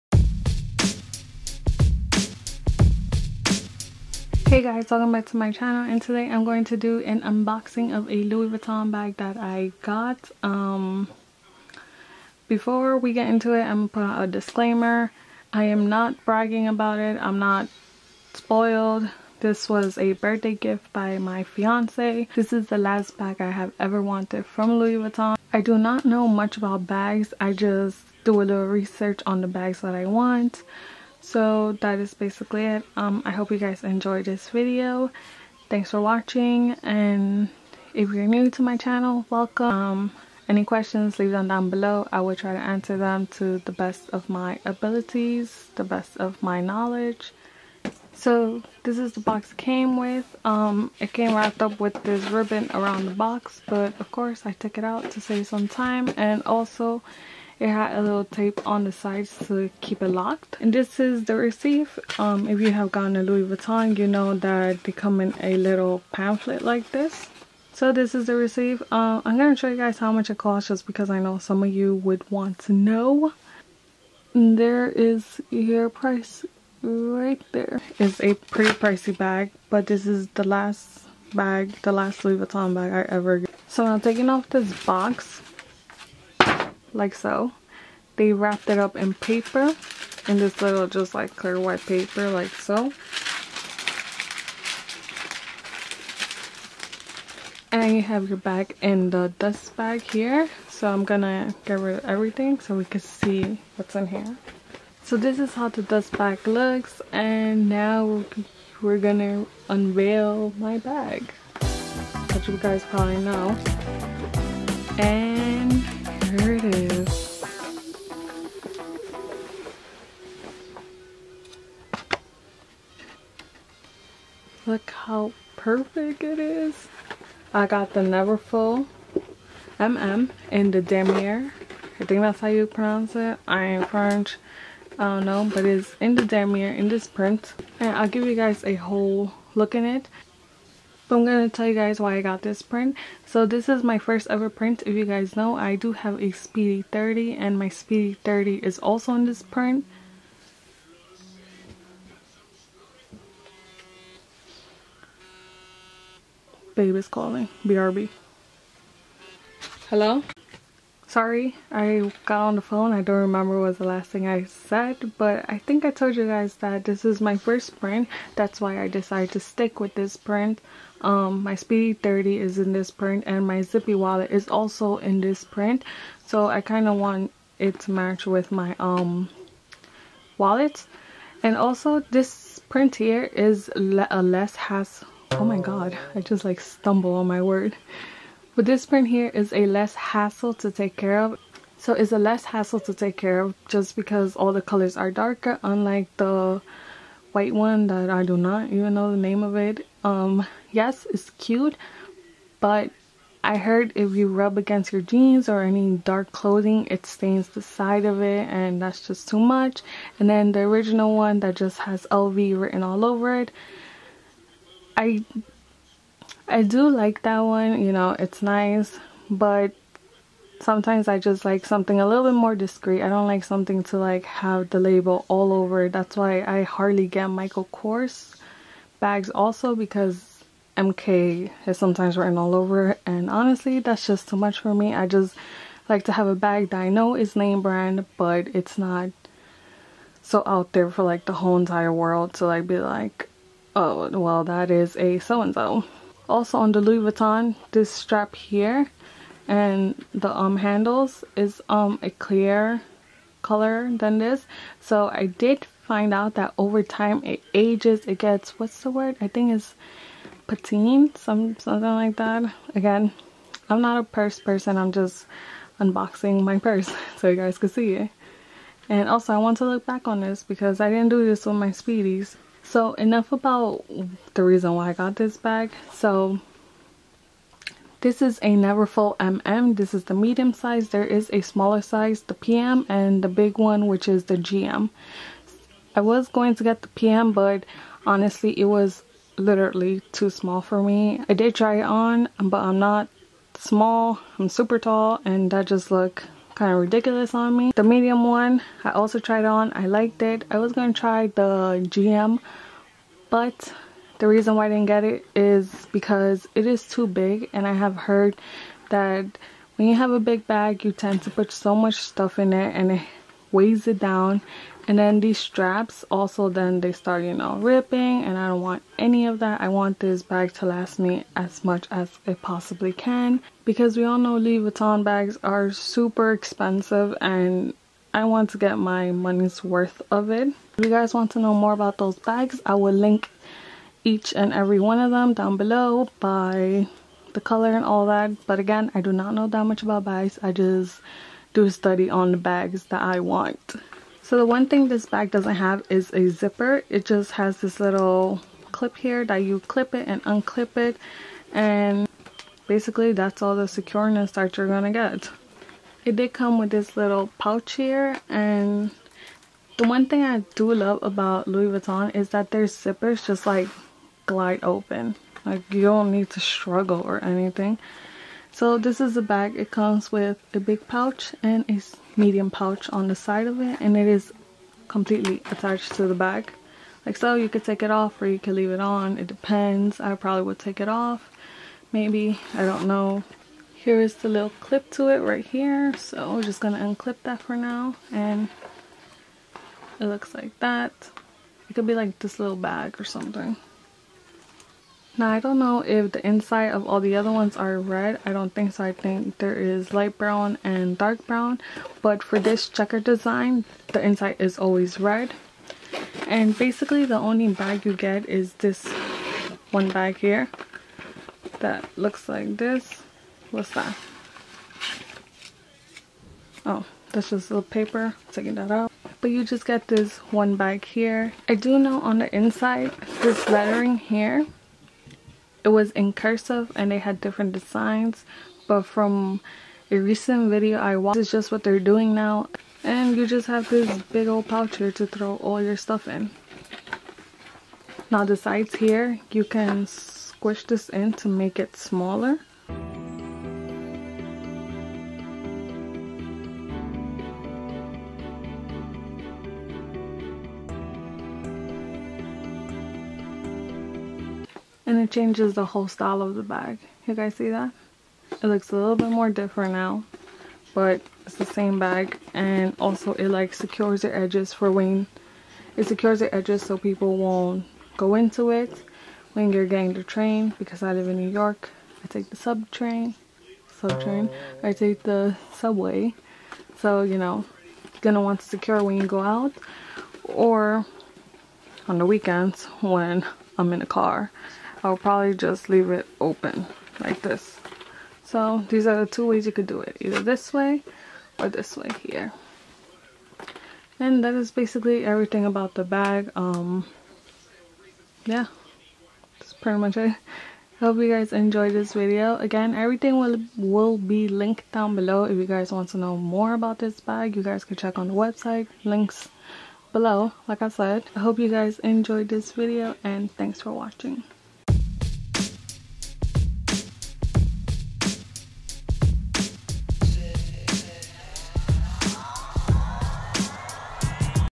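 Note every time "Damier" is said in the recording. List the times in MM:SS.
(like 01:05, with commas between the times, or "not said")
02:10, 02:16.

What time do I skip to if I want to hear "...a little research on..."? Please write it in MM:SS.
00:28.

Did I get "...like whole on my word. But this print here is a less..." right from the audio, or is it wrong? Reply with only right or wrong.
wrong.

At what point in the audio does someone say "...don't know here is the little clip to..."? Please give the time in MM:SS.
06:22.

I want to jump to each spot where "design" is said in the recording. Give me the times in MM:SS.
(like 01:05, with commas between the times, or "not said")
06:43, 07:07.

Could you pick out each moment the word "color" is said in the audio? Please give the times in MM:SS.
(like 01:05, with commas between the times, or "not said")
03:14, 04:13, 05:37.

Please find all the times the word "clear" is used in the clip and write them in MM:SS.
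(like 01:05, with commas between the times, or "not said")
01:31, 04:12.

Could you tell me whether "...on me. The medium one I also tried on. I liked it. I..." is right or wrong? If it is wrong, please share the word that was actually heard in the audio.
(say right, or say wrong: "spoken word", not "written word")
right.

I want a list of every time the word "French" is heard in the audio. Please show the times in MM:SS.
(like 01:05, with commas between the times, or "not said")
02:13.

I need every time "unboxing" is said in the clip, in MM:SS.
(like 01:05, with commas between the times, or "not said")
00:07, 04:25.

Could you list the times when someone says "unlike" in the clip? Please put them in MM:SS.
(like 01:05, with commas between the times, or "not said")
03:15.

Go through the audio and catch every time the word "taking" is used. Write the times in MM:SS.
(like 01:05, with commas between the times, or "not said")
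01:24, 06:58.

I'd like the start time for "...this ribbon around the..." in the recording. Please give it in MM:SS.
00:52.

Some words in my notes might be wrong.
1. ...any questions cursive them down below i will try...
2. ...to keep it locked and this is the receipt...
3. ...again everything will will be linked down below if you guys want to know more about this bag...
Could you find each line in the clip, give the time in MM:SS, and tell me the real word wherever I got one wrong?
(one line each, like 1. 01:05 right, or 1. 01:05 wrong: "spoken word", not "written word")
1. 00:40 wrong: "leave", not "cursive"
2. 00:59 right
3. 08:22 right.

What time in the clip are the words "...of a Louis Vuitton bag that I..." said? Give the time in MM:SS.
00:07.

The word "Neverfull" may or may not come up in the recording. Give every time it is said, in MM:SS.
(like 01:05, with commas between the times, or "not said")
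02:07, 04:38.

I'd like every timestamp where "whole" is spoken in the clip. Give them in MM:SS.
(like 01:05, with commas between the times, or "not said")
02:18, 04:01, 07:35.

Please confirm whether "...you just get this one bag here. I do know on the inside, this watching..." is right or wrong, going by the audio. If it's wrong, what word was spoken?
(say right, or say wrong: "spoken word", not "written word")
wrong: "lettering", not "watching".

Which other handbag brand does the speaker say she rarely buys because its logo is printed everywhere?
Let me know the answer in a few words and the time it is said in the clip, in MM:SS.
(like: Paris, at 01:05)
Michael Kors, at 03:47.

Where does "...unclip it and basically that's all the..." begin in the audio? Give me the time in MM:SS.
05:50.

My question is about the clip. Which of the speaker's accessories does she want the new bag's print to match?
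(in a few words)
Zippy wallet.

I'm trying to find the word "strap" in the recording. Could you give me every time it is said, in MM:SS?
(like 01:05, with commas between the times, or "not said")
04:07, 05:15.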